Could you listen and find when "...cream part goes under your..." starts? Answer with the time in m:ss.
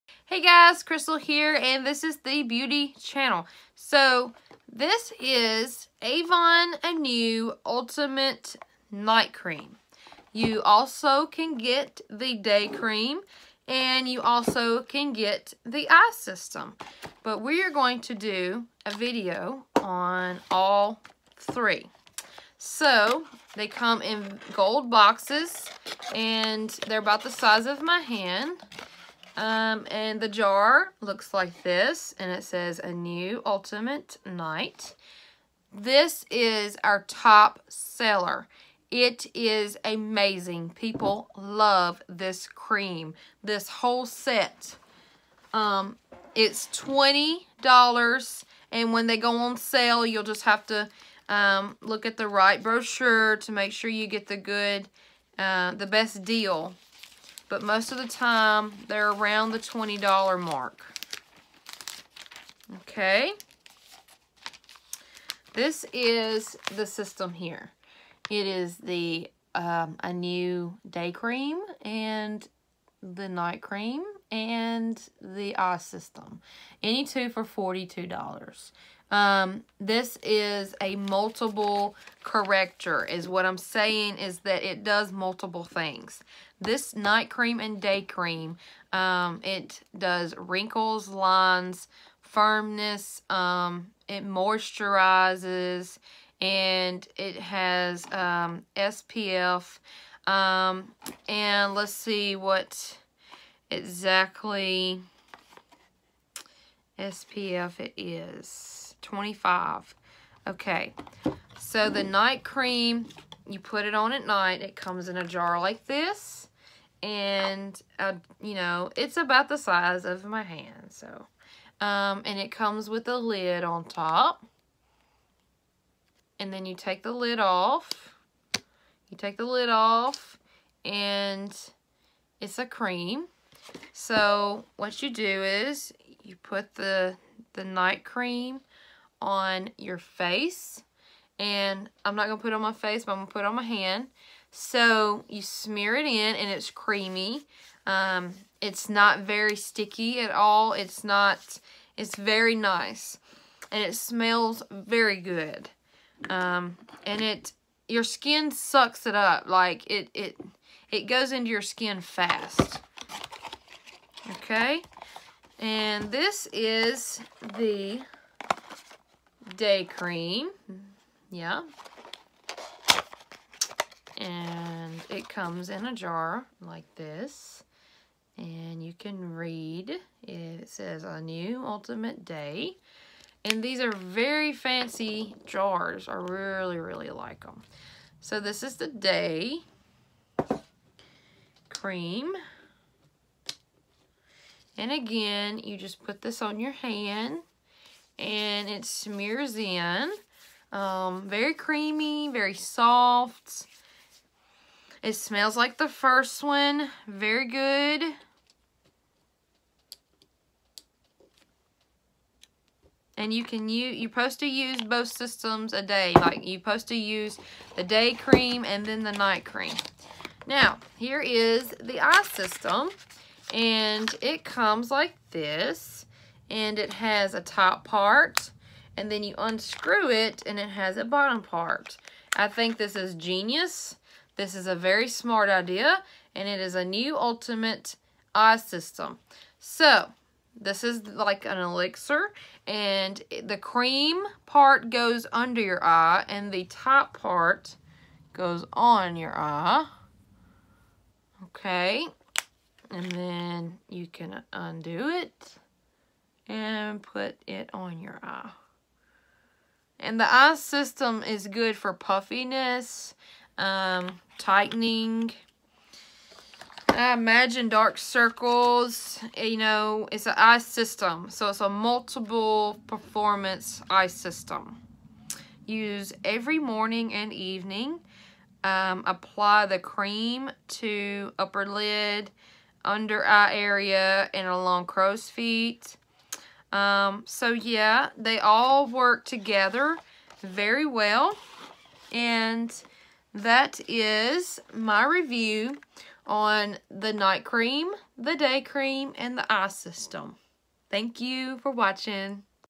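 4:03.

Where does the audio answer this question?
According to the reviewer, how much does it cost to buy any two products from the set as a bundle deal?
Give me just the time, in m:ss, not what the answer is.
1:17.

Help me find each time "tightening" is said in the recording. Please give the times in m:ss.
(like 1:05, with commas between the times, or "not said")
4:24.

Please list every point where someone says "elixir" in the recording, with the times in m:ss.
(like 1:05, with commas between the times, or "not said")
4:01.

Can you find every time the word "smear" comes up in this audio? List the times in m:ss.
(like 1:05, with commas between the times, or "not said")
2:25, 3:18.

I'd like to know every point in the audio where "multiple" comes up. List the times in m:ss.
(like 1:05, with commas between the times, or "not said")
1:20, 1:25, 4:31.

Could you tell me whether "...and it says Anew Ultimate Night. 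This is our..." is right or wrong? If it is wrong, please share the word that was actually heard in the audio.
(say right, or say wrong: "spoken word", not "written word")
right.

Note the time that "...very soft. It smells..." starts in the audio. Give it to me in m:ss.
3:22.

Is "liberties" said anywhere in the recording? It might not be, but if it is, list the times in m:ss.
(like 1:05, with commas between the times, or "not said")
not said.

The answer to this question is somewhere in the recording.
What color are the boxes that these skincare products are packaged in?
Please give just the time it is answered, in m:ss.
0:24.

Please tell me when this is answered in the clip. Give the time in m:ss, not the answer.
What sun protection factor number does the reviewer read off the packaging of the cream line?
1:49.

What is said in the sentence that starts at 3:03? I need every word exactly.
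And these are very fancy jars.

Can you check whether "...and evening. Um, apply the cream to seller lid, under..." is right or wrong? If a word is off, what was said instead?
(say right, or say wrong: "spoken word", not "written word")
wrong: "upper", not "seller".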